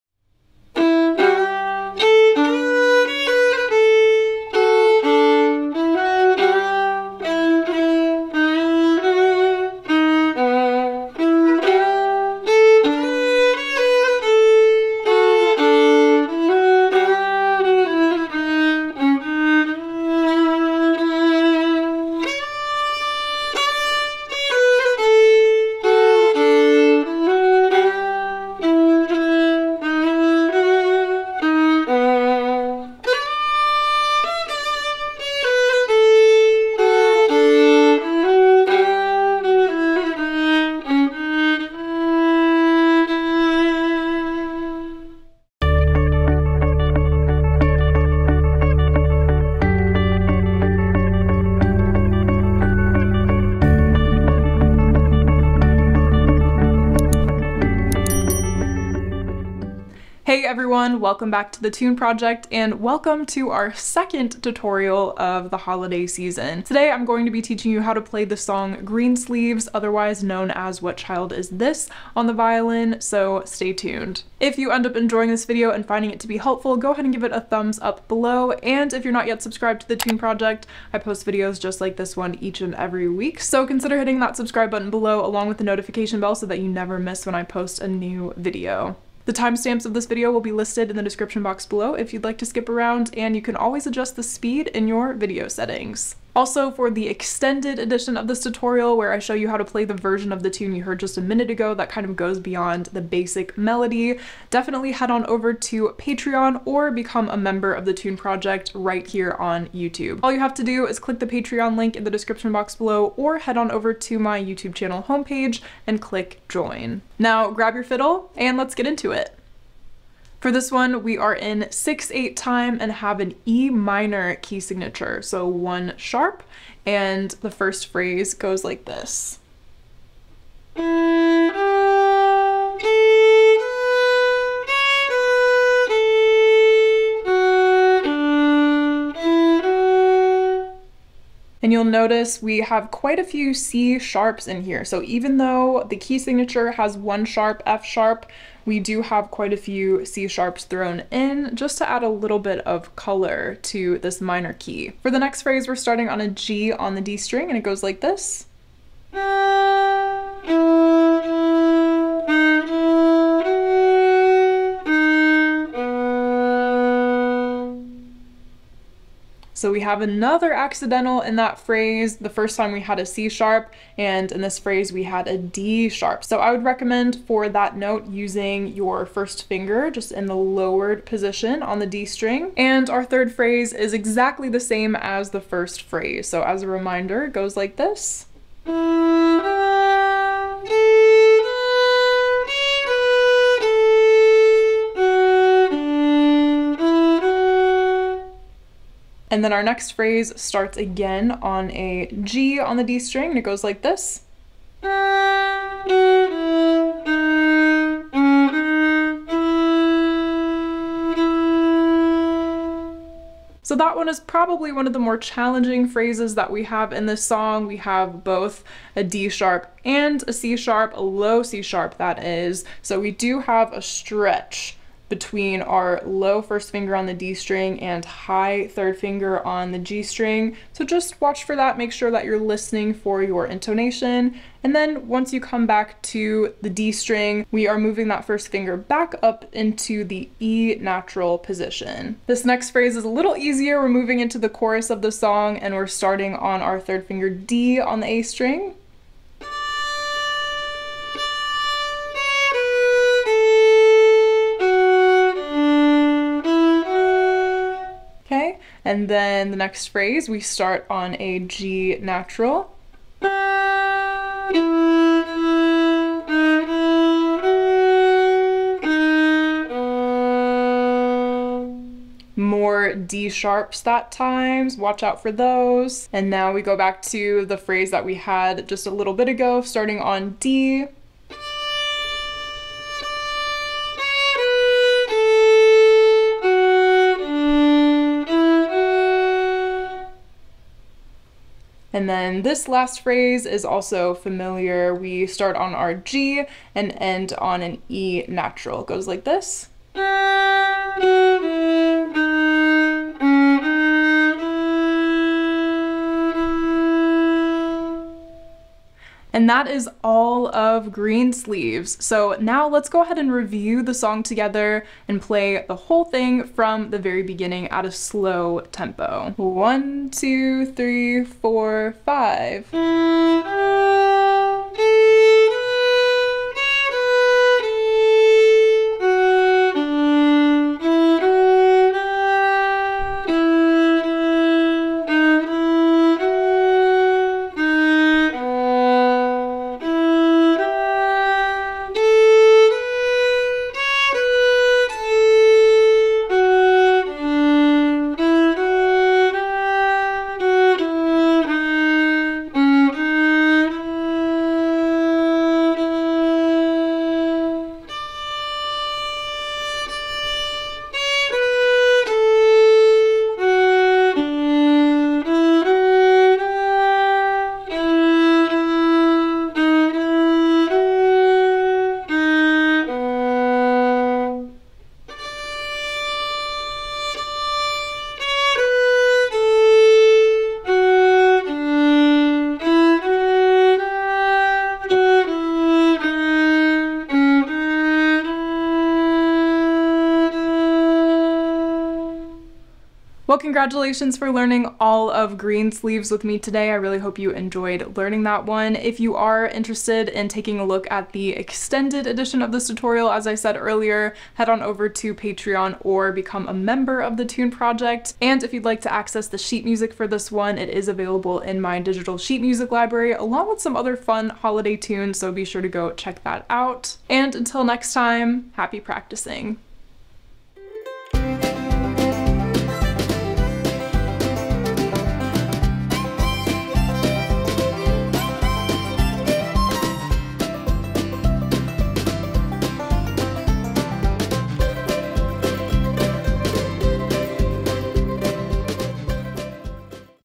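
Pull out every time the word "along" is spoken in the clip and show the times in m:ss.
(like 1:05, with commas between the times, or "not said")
1:25, 6:53.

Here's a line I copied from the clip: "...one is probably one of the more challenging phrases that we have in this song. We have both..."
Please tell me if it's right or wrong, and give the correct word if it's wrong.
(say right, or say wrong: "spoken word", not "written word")
right.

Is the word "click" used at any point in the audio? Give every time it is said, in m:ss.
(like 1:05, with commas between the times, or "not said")
1:50, 1:55.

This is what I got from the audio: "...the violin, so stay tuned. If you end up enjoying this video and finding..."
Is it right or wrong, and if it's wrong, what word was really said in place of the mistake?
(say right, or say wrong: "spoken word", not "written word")
right.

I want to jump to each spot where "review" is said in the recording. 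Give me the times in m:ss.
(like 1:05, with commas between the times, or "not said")
5:13.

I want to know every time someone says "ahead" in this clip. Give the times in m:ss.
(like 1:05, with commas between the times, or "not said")
1:16, 5:13.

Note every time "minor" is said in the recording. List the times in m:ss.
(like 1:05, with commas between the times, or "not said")
2:03, 2:34.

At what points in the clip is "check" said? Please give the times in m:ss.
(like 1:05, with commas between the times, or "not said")
6:55.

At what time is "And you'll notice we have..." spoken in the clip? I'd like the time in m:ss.
2:21.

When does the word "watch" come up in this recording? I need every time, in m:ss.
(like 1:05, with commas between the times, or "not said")
3:51, 4:34.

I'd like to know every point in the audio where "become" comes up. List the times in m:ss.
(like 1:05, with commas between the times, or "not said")
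1:46, 6:46.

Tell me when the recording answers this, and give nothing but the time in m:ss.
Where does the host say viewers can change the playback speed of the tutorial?
1:35.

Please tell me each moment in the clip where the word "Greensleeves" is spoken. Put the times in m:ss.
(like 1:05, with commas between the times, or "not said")
1:08, 5:10, 6:35.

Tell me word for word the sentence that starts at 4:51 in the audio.
And then this last phrase is also familiar.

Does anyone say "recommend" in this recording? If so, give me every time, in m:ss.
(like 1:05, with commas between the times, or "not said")
2:56.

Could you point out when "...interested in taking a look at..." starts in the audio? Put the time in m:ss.
6:39.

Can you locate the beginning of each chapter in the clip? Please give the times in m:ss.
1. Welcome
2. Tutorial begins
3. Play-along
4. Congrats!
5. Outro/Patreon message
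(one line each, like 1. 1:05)
1. 0:59
2. 1:59
3. 5:08
4. 6:32
5. 7:00.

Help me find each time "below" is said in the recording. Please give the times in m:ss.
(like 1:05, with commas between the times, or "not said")
1:18, 1:24, 1:31, 1:52.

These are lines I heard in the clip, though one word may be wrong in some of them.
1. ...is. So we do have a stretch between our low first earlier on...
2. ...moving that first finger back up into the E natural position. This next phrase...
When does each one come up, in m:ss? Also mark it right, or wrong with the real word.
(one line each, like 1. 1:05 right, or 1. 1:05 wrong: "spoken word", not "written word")
1. 3:42 wrong: "finger", not "earlier"
2. 3:57 right.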